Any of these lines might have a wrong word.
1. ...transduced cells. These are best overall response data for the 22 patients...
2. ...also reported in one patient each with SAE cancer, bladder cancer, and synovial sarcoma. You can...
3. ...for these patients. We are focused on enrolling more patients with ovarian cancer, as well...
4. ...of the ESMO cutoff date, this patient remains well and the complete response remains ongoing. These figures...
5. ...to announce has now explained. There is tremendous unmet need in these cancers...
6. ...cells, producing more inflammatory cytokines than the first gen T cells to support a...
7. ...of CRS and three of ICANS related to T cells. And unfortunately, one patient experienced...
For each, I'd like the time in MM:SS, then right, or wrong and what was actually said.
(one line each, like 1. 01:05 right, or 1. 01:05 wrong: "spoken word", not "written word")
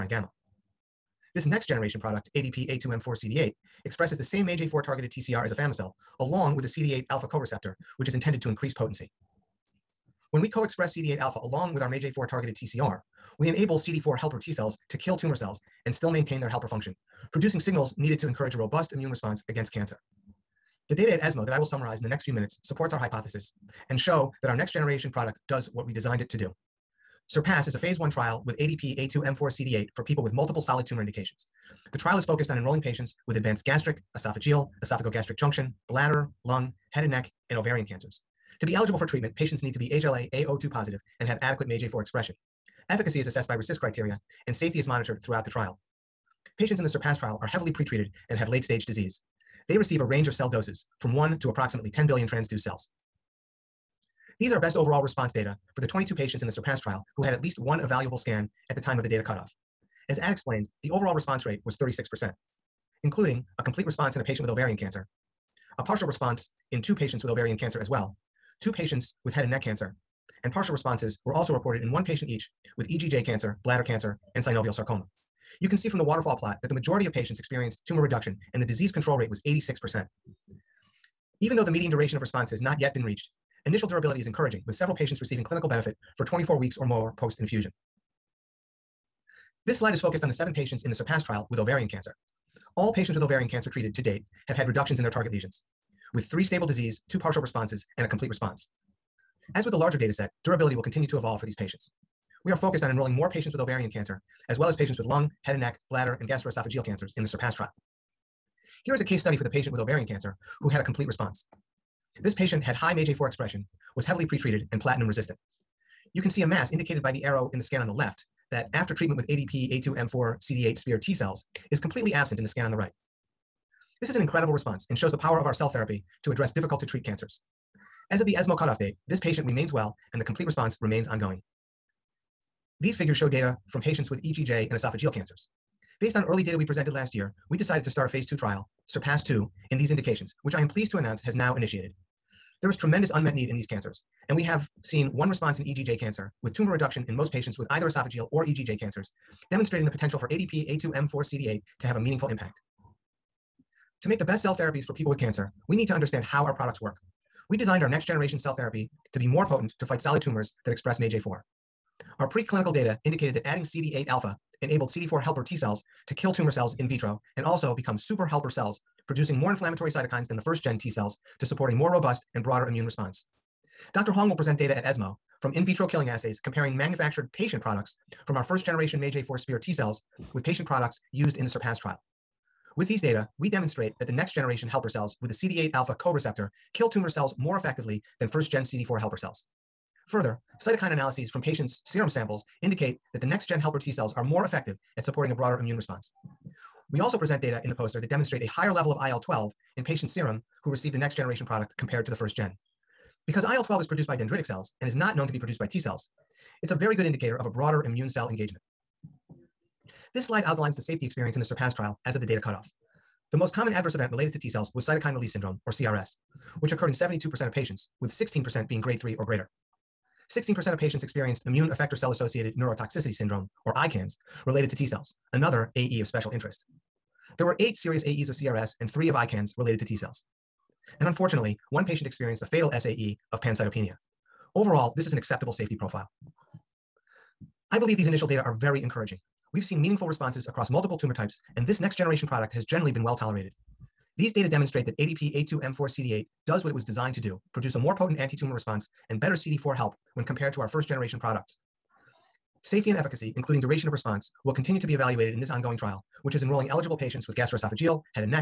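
1. 00:52 right
2. 01:11 wrong: "EGJ", not "SAE"
3. 01:41 right
4. 02:08 right
5. 02:20 wrong: "initiated", not "explained"
6. 02:48 right
7. 03:48 right.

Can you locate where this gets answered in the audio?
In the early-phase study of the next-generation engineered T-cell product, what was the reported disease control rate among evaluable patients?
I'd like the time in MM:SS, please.
01:19.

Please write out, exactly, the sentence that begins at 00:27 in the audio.
SURPASS is a phase one trial with ADP A2M4CD8 for people with multiple solid tumor indications.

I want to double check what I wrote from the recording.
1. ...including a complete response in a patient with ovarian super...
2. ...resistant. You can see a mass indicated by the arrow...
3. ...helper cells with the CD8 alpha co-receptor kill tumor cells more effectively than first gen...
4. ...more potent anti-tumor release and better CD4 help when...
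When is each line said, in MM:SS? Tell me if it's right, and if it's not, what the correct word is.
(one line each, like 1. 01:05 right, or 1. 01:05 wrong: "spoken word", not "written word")
1. 01:03 wrong: "cancer", not "super"
2. 01:55 right
3. 03:04 right
4. 04:07 wrong: "response", not "release".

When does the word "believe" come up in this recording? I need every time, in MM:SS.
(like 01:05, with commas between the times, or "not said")
03:57.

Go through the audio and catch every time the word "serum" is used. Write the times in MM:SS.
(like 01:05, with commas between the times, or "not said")
03:11, 03:20.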